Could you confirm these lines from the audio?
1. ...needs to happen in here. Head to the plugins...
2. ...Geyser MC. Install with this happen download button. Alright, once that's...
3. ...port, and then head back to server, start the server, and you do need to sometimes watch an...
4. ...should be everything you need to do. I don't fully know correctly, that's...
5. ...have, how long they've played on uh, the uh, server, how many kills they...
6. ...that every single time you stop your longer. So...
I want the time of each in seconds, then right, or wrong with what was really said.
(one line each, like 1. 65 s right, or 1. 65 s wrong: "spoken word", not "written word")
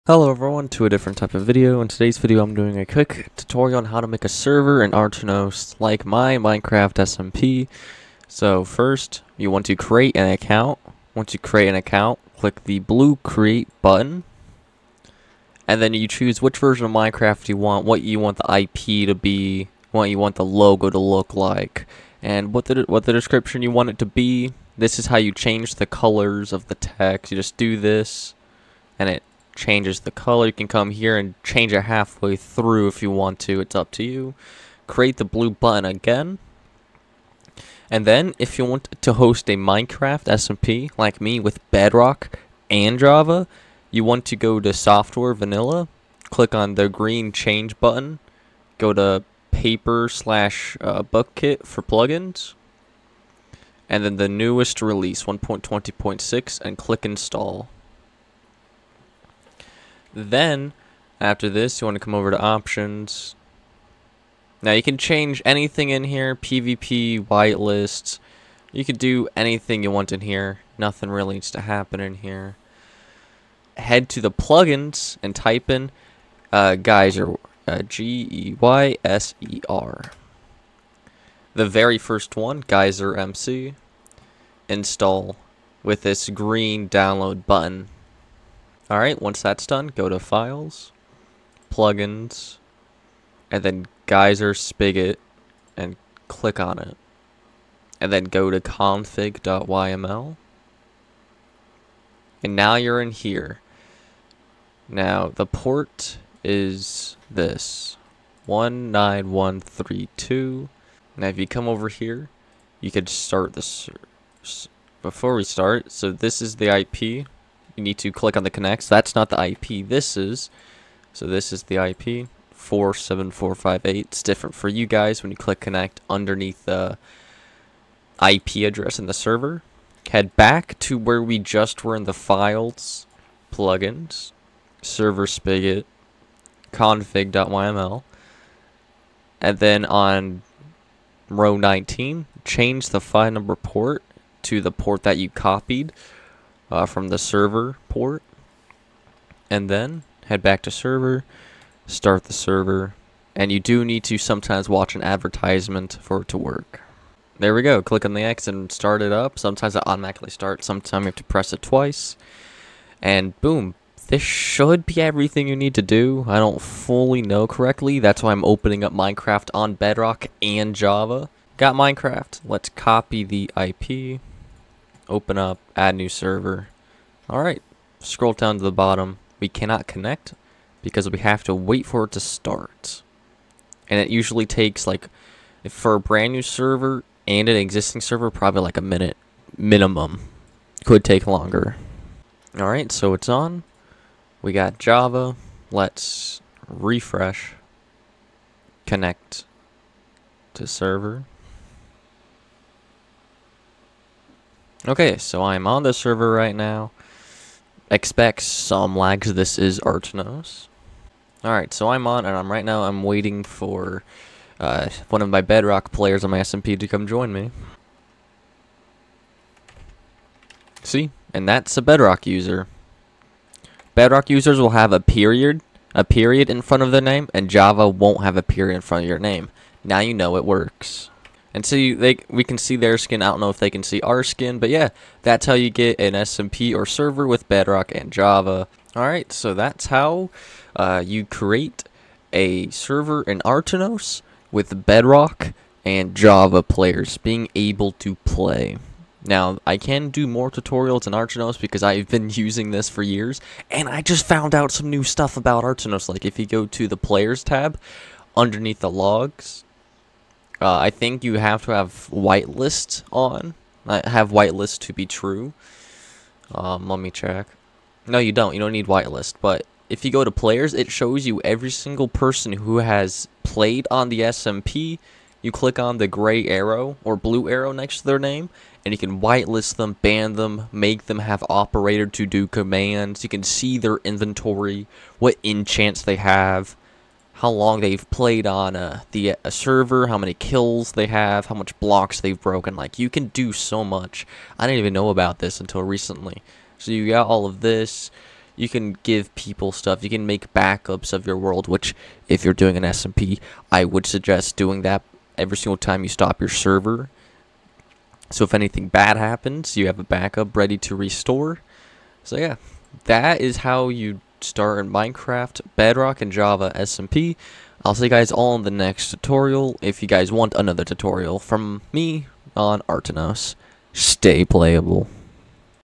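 1. 71 s right
2. 82 s wrong: "green", not "happen"
3. 147 s right
4. 164 s right
5. 286 s right
6. 304 s wrong: "server", not "longer".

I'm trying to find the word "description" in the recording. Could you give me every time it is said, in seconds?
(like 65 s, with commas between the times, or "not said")
23 s.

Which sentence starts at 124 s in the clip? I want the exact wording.
It's different for you guys when you click connect underneath the IP address in the server.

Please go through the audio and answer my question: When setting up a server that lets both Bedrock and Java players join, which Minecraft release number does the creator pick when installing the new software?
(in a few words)
1.20.6.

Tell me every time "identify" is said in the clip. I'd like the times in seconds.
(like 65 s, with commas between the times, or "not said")
not said.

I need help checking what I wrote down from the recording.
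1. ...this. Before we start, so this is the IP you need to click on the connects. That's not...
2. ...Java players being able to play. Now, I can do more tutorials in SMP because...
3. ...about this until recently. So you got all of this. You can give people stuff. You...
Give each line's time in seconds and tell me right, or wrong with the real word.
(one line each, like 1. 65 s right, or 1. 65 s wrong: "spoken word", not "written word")
1. 113 s right
2. 246 s wrong: "Aternos", not "SMP"
3. 295 s right.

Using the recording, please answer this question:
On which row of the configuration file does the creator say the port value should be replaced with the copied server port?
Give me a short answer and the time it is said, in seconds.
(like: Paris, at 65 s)
19, at 141 s.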